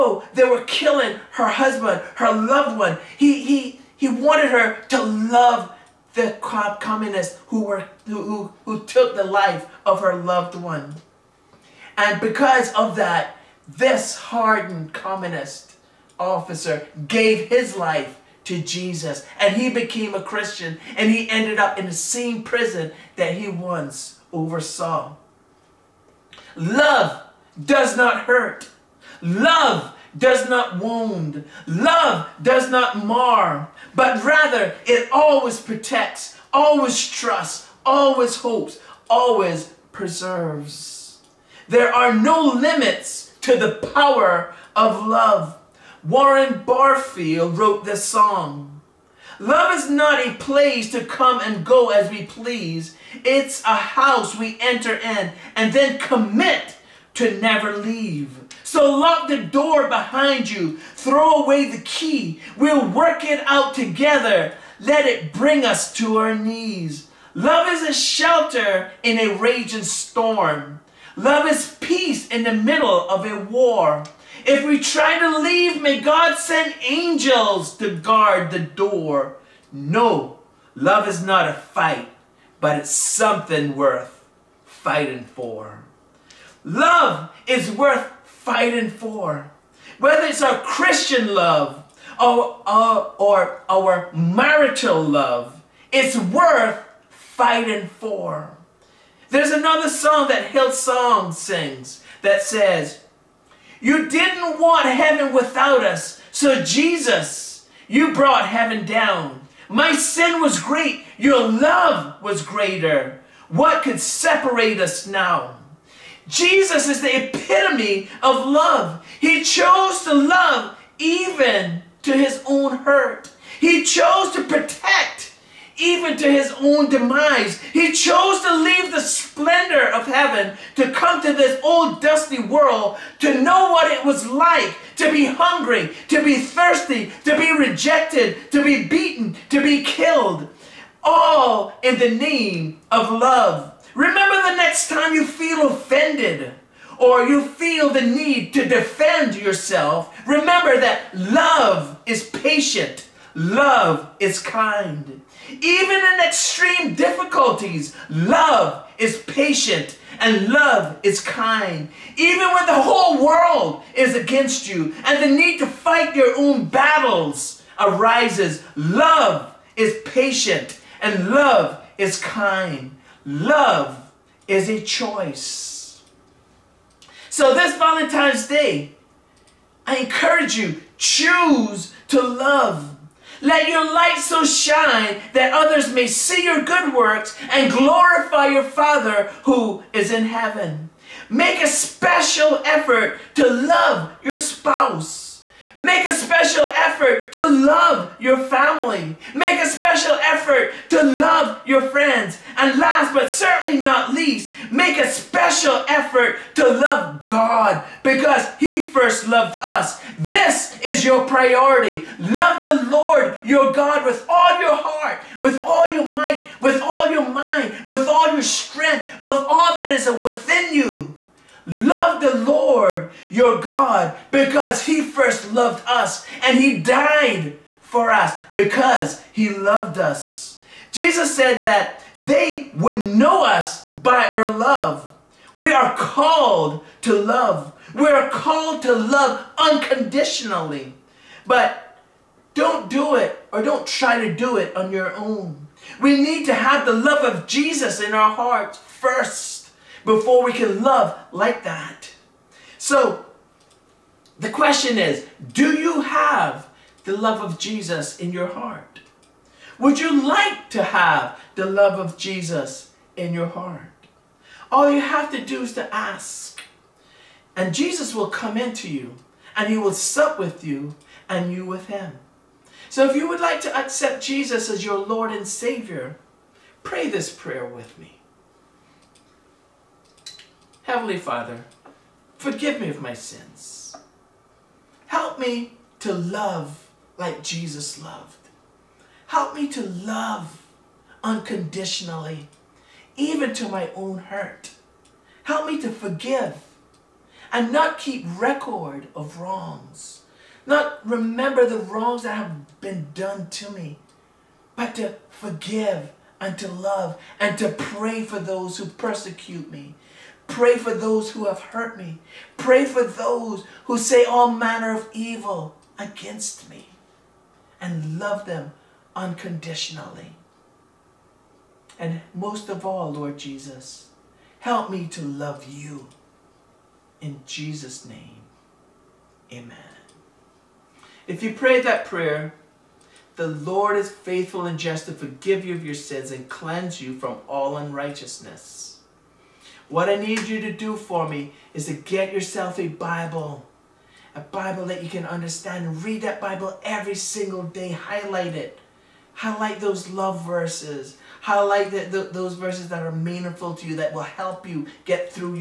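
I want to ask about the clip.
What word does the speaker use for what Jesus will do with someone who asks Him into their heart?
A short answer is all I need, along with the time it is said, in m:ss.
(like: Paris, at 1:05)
Sup, at 4:29.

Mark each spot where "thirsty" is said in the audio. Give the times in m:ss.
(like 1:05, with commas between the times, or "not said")
2:16.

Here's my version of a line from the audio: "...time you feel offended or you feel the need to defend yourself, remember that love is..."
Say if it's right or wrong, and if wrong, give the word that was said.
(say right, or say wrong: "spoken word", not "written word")
right.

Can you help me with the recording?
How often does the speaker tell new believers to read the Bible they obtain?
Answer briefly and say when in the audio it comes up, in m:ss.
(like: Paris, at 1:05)
Every single day, at 5:46.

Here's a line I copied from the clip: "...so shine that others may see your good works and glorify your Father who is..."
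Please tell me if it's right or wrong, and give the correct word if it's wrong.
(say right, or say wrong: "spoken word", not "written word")
right.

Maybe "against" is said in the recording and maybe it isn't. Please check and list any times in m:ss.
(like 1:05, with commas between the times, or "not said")
2:44, 5:15.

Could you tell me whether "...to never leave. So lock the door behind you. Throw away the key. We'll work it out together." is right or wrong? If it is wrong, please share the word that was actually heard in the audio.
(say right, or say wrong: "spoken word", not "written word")
right.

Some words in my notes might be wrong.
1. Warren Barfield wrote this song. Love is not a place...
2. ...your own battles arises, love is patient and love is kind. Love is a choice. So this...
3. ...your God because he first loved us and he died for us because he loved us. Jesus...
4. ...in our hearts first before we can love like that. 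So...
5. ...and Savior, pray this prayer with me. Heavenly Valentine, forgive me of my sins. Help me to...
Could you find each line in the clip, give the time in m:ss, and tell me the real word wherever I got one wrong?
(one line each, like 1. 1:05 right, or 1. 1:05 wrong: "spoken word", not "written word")
1. 0:46 right
2. 2:46 right
3. 3:43 right
4. 4:07 right
5. 4:35 wrong: "Father", not "Valentine".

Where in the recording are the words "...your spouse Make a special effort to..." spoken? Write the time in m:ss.
3:14.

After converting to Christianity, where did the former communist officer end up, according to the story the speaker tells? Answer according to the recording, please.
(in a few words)
The same prison.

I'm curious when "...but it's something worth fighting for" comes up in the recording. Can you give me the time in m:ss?
1:22.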